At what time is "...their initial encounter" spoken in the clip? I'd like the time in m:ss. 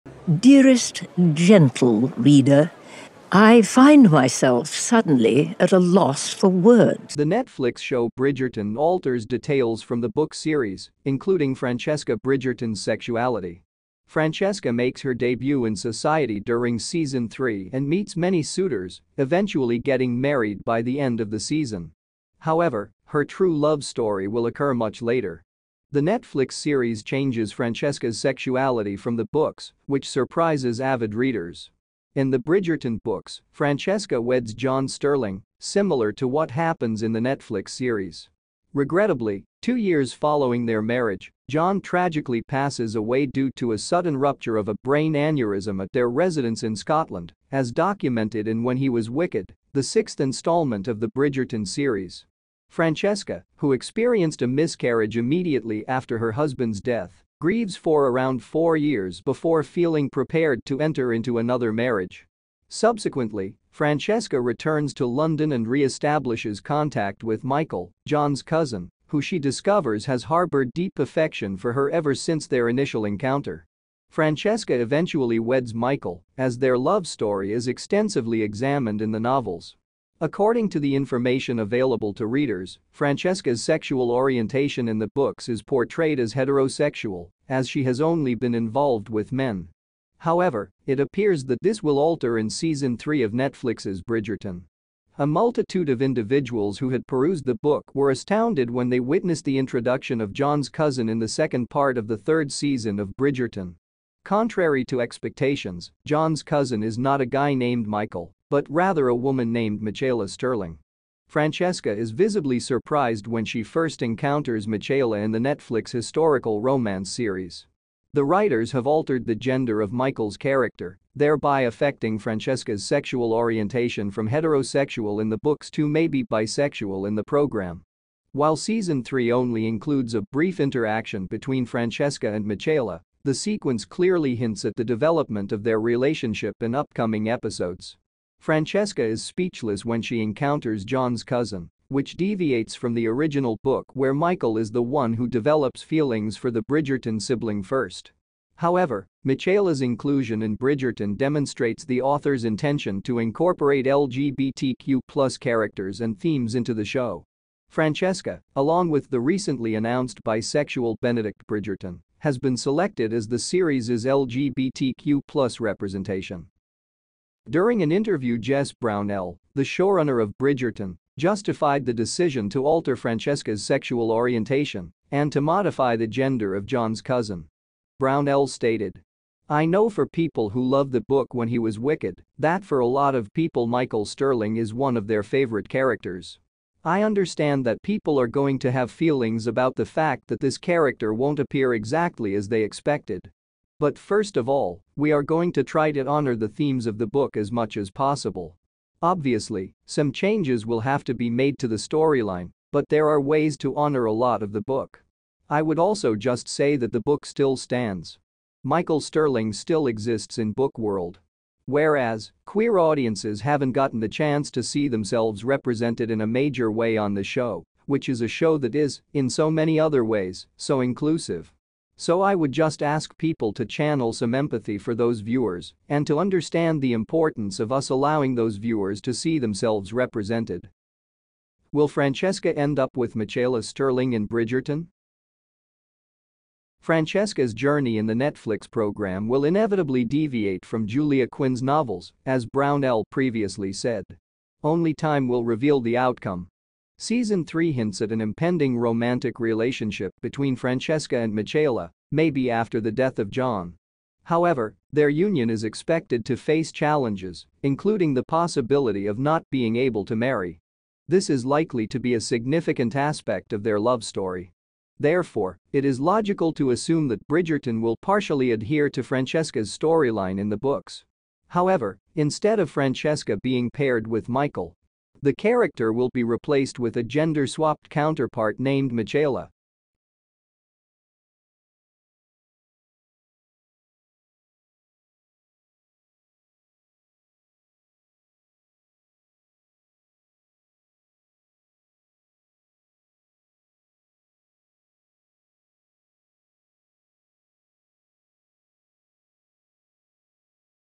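1:12.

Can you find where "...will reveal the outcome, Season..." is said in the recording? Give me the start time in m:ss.
4:05.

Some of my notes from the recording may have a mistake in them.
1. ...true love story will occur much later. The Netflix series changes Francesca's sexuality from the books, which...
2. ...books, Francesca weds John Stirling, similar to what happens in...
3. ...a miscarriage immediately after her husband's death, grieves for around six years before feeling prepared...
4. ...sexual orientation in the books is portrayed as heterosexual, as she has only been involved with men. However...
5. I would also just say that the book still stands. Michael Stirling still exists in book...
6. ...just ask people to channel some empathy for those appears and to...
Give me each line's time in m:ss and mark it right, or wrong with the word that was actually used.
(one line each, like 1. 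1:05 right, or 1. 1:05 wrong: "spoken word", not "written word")
1. 0:23 right
2. 0:33 right
3. 0:54 wrong: "four", not "six"
4. 1:23 right
5. 3:25 right
6. 3:42 wrong: "viewers", not "appears".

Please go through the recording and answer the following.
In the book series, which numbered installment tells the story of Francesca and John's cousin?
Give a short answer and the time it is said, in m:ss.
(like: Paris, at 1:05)
6th, at 0:49.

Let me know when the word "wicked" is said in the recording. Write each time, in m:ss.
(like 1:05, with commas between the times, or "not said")
0:49, 3:01.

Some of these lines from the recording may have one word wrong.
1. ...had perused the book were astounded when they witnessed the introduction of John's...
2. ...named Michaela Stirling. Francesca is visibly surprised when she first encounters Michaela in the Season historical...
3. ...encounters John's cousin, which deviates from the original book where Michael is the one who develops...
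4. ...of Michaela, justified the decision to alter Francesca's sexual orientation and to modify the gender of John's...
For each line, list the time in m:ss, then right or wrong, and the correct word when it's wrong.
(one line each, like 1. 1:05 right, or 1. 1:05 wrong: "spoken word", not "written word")
1. 1:36 right
2. 1:49 wrong: "Netflix", not "Season"
3. 2:20 right
4. 2:50 wrong: "Bridgerton", not "Michaela".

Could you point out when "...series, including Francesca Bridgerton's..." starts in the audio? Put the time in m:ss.
0:10.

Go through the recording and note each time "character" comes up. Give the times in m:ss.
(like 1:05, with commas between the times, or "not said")
2:00, 2:35, 3:05, 3:10, 4:35.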